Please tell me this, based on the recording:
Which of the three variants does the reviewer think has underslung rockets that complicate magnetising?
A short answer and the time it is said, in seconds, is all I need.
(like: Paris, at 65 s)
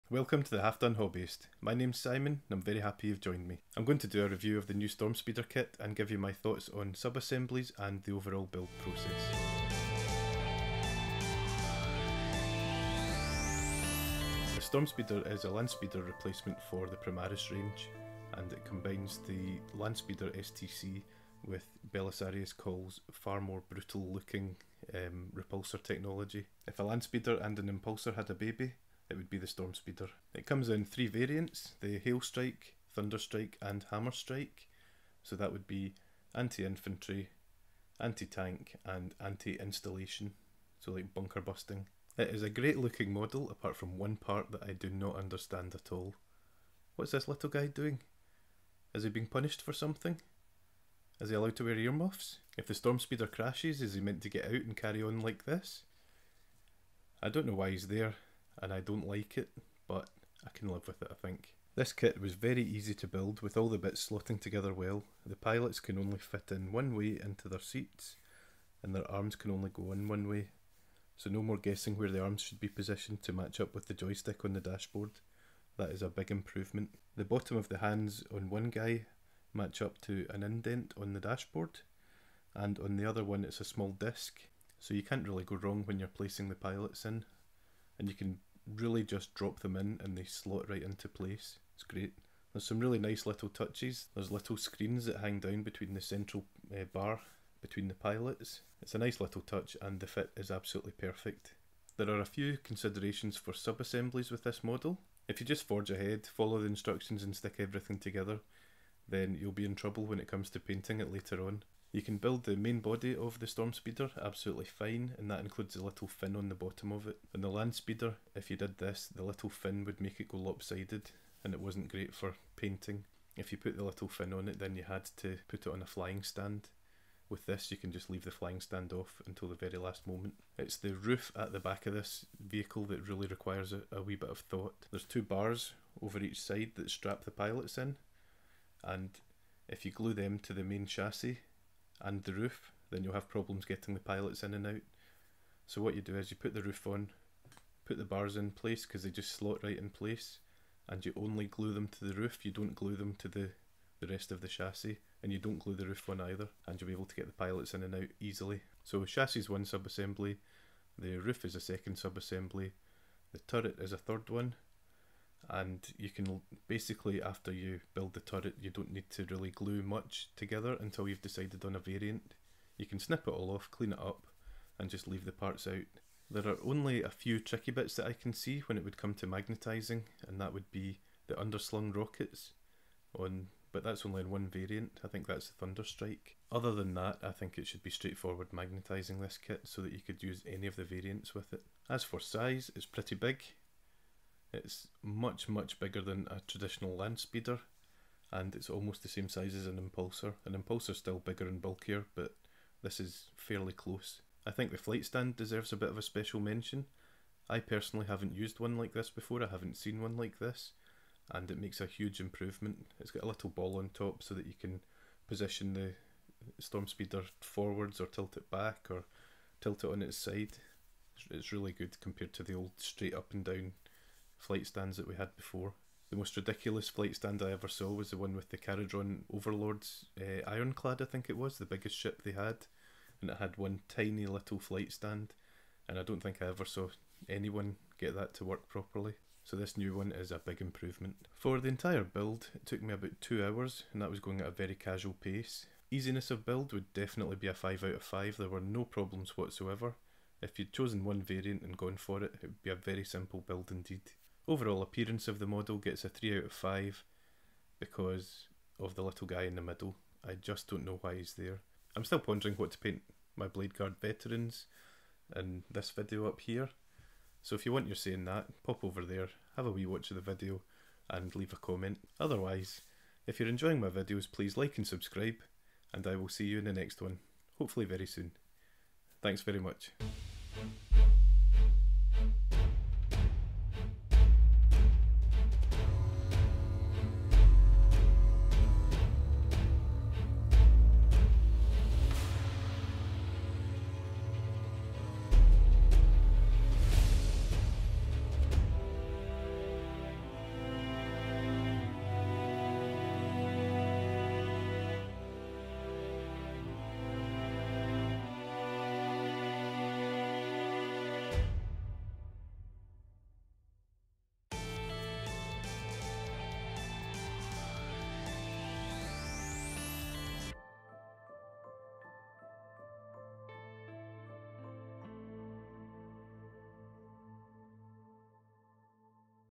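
Thunderstrike, at 185 s.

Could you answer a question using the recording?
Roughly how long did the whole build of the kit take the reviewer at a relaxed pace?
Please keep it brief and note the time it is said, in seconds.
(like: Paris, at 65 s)
2 hours, at 243 s.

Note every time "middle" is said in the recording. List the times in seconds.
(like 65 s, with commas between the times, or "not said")
259 s.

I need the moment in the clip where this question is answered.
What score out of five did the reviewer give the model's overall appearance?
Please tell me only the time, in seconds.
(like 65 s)
256 s.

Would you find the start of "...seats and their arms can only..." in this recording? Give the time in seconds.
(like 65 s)
67 s.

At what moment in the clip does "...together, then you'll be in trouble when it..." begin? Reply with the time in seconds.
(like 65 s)
107 s.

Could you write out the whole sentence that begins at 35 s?
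So that would be anti-infantry, anti-tank and anti-installation, so like bunker busting.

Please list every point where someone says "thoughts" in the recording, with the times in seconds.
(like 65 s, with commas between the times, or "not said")
6 s, 134 s.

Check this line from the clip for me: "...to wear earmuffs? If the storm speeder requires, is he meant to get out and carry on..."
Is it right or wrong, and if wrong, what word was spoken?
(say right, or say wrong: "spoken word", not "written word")
wrong: "crashes", not "requires".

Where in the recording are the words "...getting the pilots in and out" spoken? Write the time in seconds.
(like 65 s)
143 s.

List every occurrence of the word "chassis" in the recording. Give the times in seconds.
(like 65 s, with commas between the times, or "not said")
140 s, 154 s, 159 s.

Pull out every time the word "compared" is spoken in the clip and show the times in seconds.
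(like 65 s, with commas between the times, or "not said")
222 s.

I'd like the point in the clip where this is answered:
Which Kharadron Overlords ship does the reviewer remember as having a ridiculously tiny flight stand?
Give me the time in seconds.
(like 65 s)
230 s.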